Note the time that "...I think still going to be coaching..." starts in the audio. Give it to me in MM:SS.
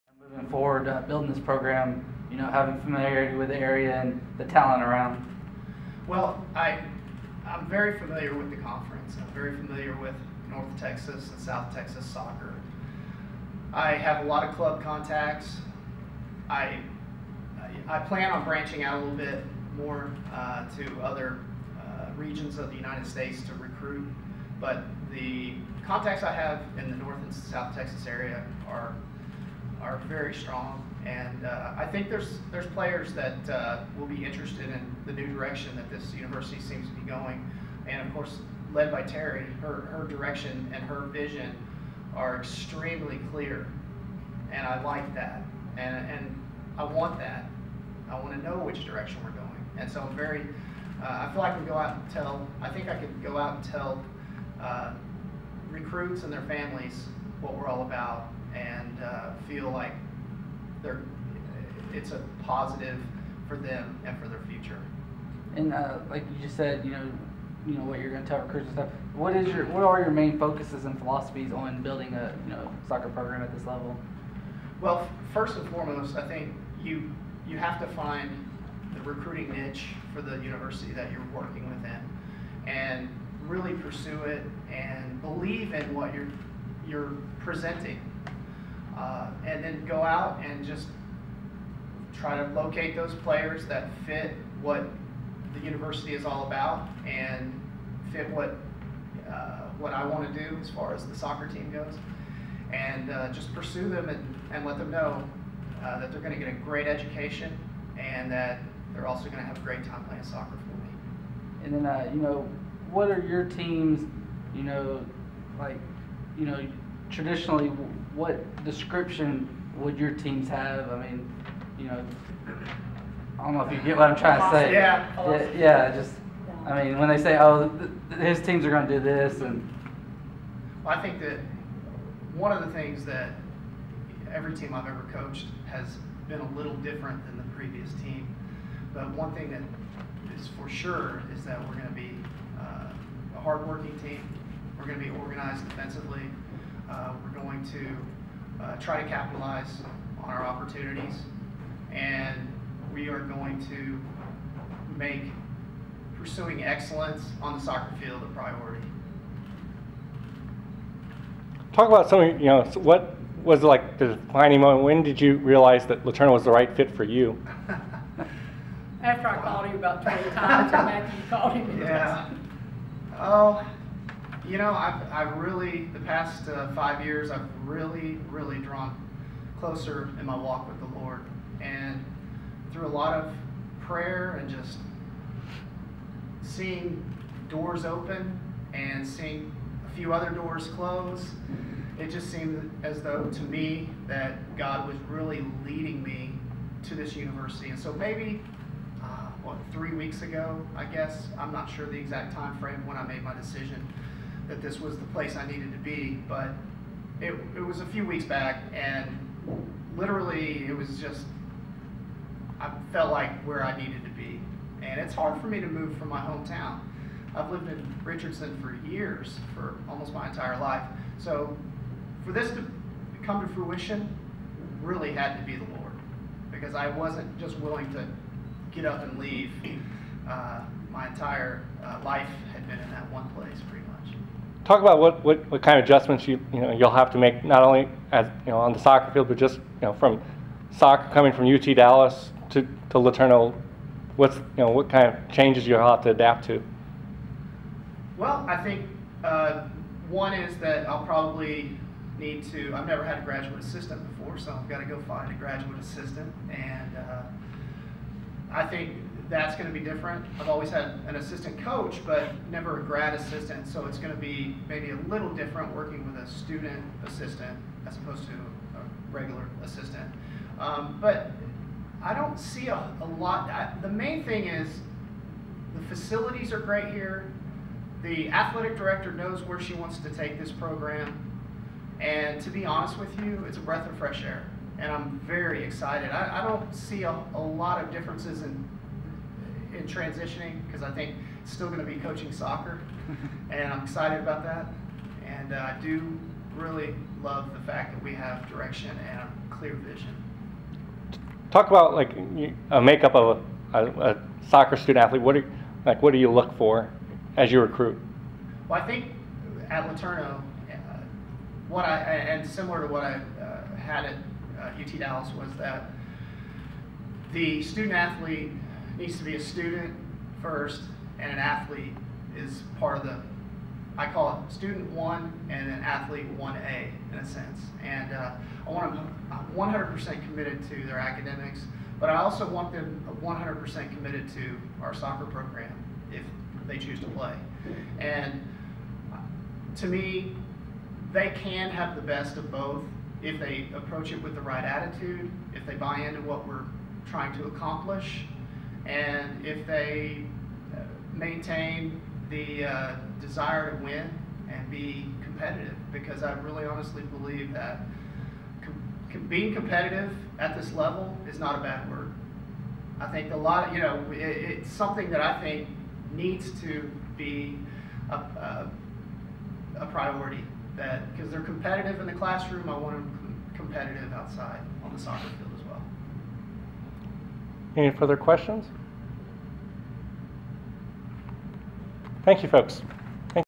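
04:50.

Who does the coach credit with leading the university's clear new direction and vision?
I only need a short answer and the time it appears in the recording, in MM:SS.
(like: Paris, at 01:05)
Terry, at 00:39.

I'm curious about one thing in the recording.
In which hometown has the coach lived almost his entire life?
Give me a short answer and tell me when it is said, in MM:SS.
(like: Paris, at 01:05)
Richardson, at 03:38.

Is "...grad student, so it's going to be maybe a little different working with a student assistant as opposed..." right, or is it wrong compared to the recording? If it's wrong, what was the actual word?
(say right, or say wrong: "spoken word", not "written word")
wrong: "assistant", not "student".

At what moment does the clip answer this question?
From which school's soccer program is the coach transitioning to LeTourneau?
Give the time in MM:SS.
04:01.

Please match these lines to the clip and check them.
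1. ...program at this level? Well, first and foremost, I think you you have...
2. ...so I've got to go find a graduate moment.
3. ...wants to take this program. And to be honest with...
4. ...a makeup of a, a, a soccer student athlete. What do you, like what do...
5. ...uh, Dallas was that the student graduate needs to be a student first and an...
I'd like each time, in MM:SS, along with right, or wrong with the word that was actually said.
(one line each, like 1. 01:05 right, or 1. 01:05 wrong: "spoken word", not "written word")
1. 01:13 right
2. 04:14 wrong: "assistant", not "moment"
3. 04:39 right
4. 05:02 right
5. 05:14 wrong: "athlete", not "graduate".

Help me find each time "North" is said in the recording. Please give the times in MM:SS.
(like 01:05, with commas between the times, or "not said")
00:10, 00:26.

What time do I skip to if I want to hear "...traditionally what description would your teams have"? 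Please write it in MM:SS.
01:57.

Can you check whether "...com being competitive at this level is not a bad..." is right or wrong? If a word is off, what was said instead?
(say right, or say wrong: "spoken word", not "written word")
right.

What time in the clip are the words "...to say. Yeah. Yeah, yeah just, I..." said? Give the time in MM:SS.
02:04.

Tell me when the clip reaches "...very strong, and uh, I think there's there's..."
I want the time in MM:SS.
00:30.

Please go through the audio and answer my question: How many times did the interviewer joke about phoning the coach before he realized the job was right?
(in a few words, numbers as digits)
20.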